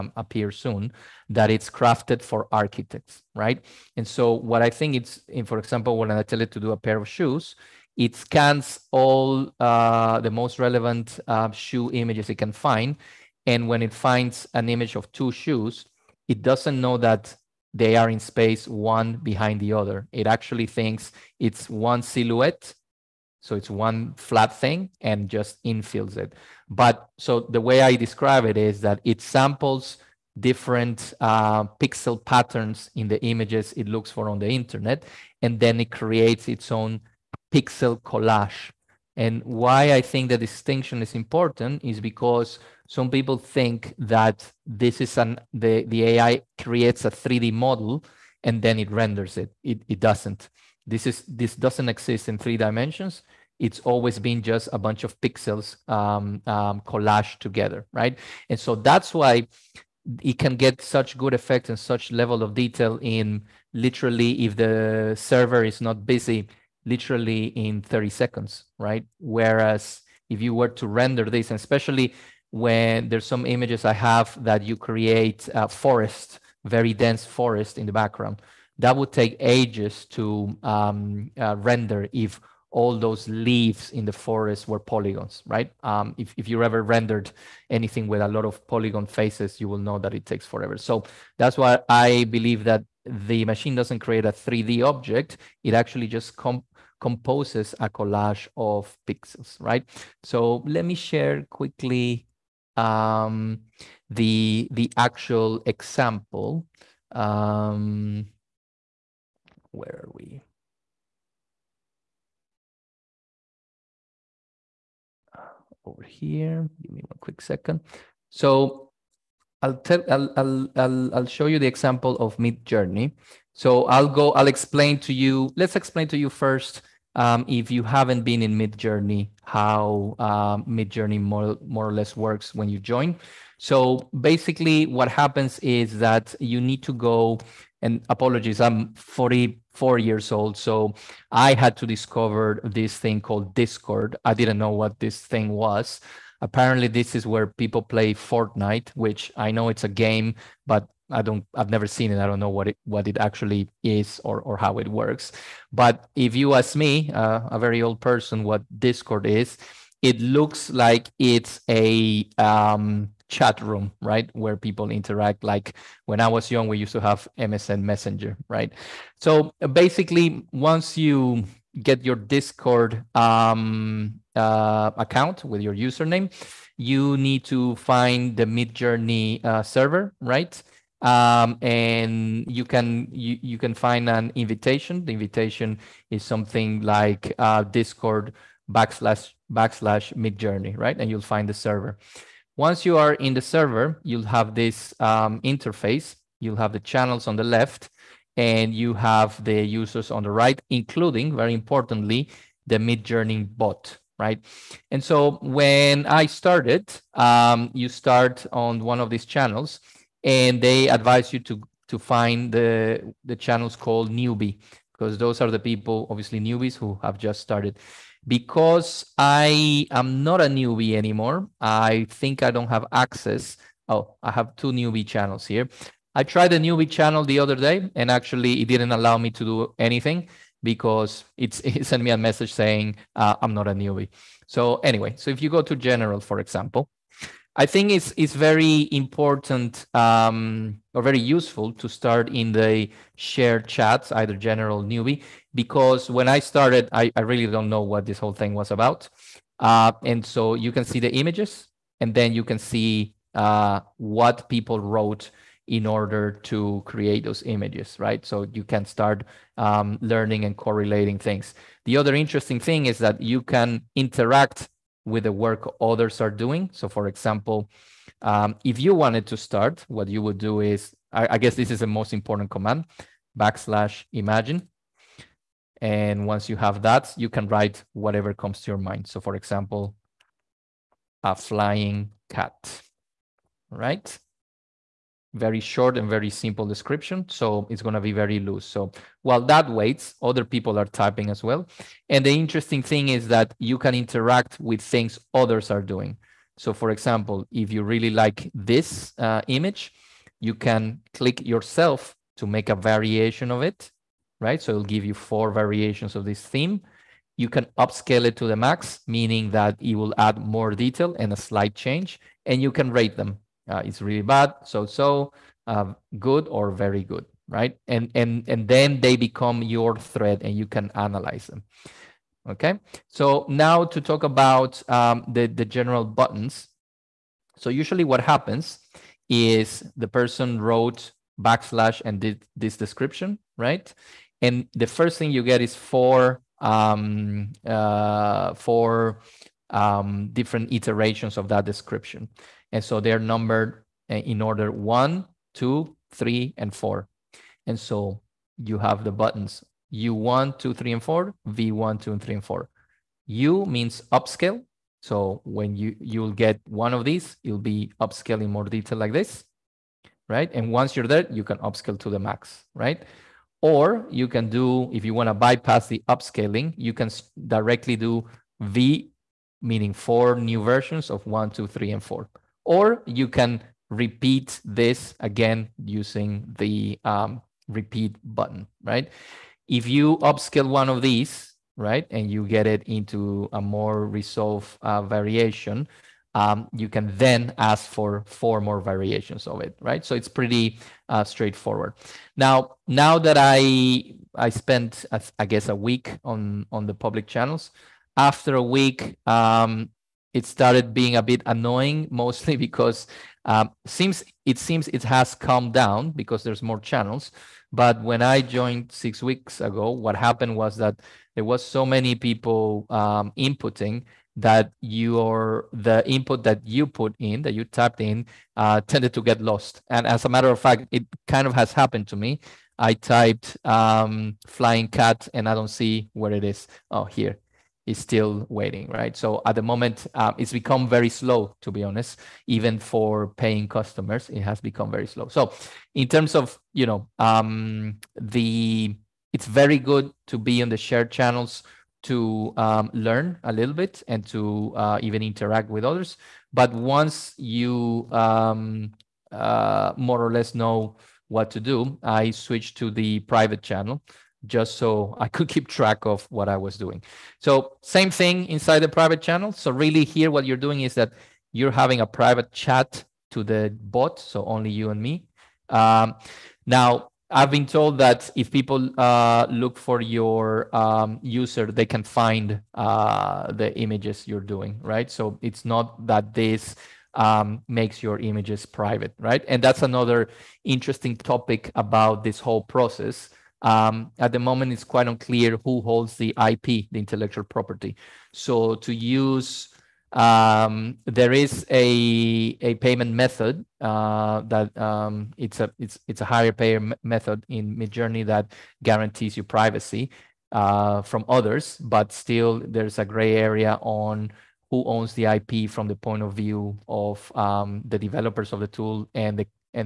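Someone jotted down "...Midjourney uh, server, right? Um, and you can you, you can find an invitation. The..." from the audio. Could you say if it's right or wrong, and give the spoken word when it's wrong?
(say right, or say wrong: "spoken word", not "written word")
right.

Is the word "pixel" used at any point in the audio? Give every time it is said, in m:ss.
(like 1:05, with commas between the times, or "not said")
0:31, 0:37, 0:55, 1:39.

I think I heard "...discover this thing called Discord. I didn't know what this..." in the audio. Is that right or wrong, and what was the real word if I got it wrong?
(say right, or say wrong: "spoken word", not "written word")
right.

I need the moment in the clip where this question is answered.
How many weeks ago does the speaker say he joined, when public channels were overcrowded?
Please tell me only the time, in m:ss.
6:48.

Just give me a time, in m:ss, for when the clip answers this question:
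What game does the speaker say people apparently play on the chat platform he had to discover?
2:28.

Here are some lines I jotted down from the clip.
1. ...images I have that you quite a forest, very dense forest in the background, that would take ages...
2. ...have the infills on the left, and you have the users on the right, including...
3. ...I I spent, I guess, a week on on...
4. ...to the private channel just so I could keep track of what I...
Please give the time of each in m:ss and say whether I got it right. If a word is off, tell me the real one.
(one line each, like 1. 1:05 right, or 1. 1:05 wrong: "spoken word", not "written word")
1. 1:13 wrong: "create", not "quite"
2. 3:16 wrong: "channels", not "infills"
3. 6:33 right
4. 7:32 right.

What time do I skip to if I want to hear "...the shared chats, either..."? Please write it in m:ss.
4:02.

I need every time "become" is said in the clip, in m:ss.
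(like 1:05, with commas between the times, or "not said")
5:19, 7:10, 7:14.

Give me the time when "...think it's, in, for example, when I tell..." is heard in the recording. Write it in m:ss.
0:04.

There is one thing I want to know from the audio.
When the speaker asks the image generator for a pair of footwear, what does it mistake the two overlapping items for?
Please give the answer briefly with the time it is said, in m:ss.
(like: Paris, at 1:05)
One silhouette, at 0:21.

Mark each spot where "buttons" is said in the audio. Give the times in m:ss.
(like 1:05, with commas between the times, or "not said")
5:26, 5:49, 6:18.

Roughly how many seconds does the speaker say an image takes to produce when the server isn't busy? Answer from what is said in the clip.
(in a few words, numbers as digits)
30 seconds.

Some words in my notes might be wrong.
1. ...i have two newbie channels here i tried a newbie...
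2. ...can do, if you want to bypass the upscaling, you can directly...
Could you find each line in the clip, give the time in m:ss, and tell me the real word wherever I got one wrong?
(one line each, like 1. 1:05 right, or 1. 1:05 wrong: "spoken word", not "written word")
1. 3:44 right
2. 6:04 right.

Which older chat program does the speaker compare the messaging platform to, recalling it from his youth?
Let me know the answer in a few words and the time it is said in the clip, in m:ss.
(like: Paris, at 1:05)
MSN Messenger, at 2:47.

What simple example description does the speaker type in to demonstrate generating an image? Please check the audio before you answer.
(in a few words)
A flying cat.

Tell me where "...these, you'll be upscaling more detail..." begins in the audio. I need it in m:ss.
5:57.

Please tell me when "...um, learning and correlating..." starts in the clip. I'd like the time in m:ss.
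4:19.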